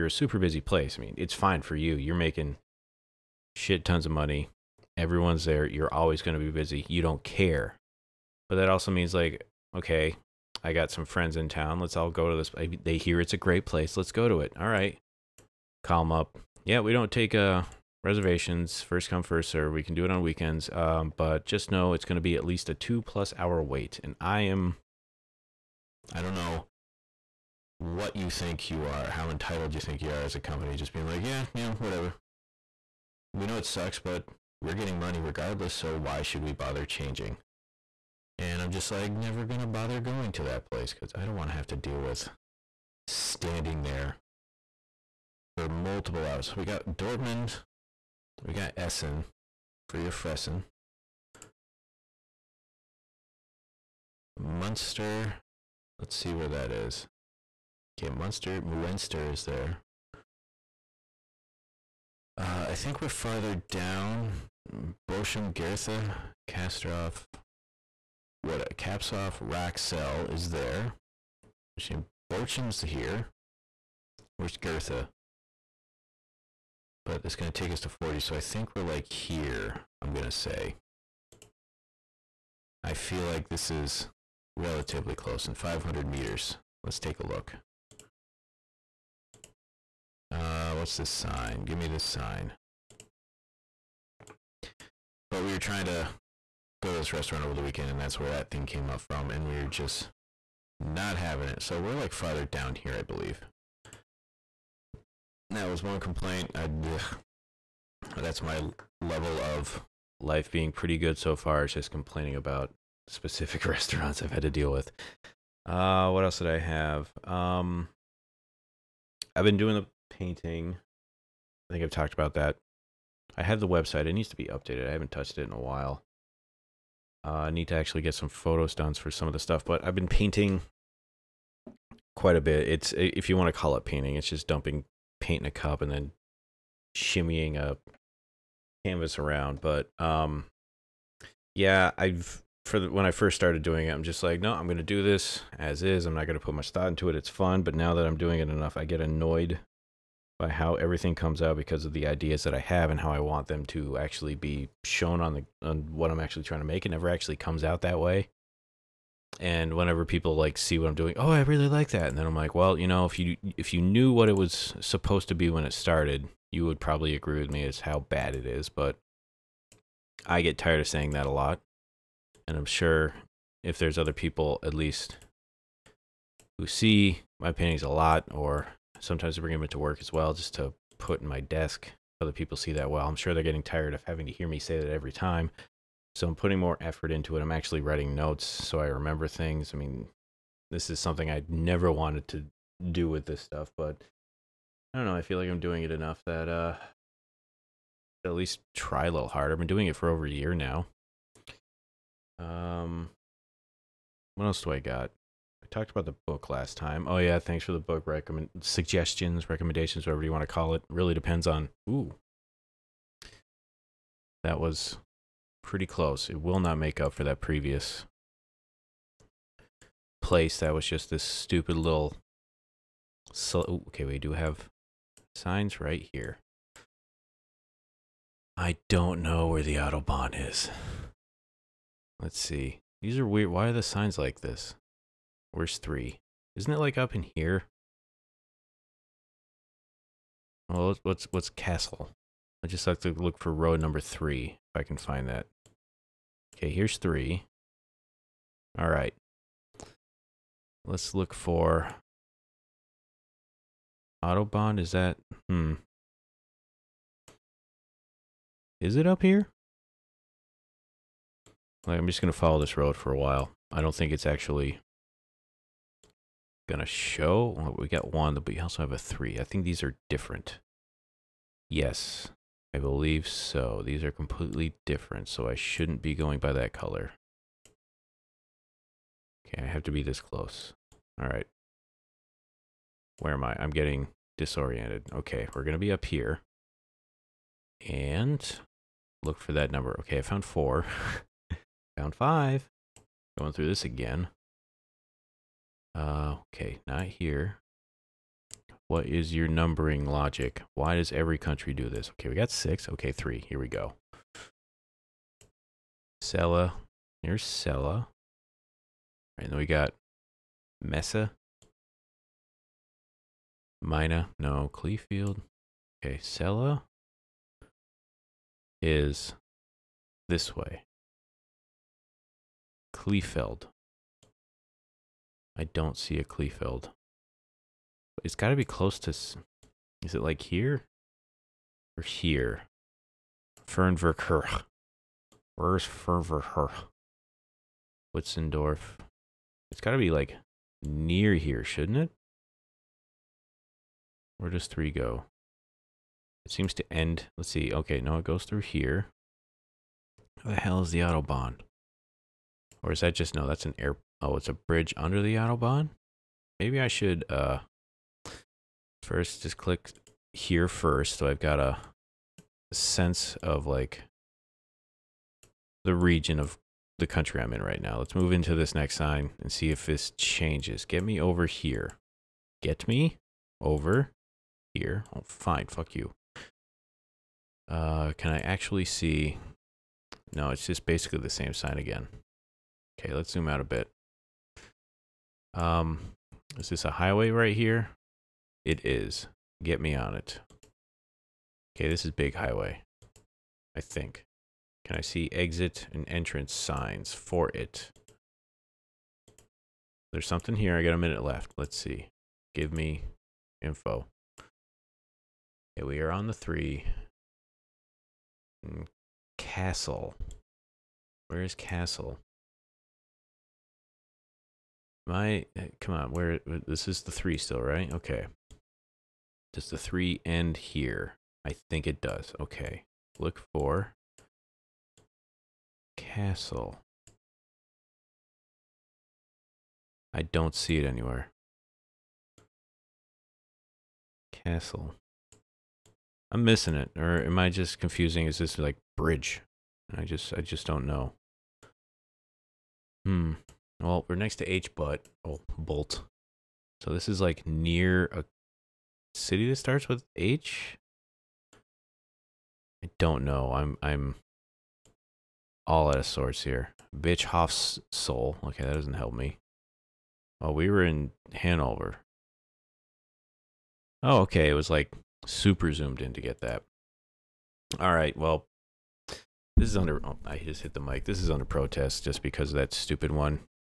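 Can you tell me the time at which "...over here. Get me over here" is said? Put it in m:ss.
6:11.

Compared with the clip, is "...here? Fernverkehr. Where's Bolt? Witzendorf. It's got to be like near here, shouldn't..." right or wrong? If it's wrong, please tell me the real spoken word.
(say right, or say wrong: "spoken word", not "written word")
wrong: "Fernverkehr", not "Bolt".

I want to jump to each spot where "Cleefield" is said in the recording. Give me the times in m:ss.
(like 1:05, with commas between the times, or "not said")
5:14, 5:22.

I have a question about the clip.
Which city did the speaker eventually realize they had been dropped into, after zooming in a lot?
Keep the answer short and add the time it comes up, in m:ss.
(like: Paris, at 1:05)
Hanover, at 7:41.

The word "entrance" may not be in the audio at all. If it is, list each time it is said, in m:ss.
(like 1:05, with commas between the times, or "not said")
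6:36.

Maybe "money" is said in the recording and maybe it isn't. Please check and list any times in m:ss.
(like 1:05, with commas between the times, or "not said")
0:04, 0:34.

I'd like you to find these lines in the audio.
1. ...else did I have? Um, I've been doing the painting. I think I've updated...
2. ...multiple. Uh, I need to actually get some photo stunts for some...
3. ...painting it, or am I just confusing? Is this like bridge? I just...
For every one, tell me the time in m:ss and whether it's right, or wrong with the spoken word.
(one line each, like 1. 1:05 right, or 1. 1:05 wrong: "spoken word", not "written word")
1. 1:56 wrong: "talked", not "updated"
2. 2:05 wrong: "while", not "multiple"
3. 7:16 wrong: "missing", not "painting".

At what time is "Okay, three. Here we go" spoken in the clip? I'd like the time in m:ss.
5:02.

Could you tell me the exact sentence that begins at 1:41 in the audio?
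So we're like farther down here, I believe.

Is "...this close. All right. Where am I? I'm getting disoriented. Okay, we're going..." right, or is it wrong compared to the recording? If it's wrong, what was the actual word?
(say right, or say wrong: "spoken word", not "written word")
right.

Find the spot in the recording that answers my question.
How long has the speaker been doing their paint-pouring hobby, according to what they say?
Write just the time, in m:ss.
3:20.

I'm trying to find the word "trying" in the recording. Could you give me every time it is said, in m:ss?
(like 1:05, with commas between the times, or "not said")
1:35, 2:36.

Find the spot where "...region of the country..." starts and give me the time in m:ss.
6:05.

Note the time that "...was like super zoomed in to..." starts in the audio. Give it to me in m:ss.
7:44.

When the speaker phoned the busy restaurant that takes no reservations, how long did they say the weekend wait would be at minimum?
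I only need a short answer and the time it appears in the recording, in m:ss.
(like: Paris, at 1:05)
2 plus hours, at 0:22.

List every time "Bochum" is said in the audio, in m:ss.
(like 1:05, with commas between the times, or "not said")
1:05, 1:12.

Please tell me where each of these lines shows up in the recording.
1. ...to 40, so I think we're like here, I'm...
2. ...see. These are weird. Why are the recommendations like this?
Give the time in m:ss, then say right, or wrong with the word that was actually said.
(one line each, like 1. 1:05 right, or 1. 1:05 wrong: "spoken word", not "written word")
1. 1:17 right
2. 3:52 wrong: "signs", not "recommendations".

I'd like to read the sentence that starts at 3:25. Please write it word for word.
talked about the book last time.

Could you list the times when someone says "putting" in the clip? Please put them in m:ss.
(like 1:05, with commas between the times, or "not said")
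3:06.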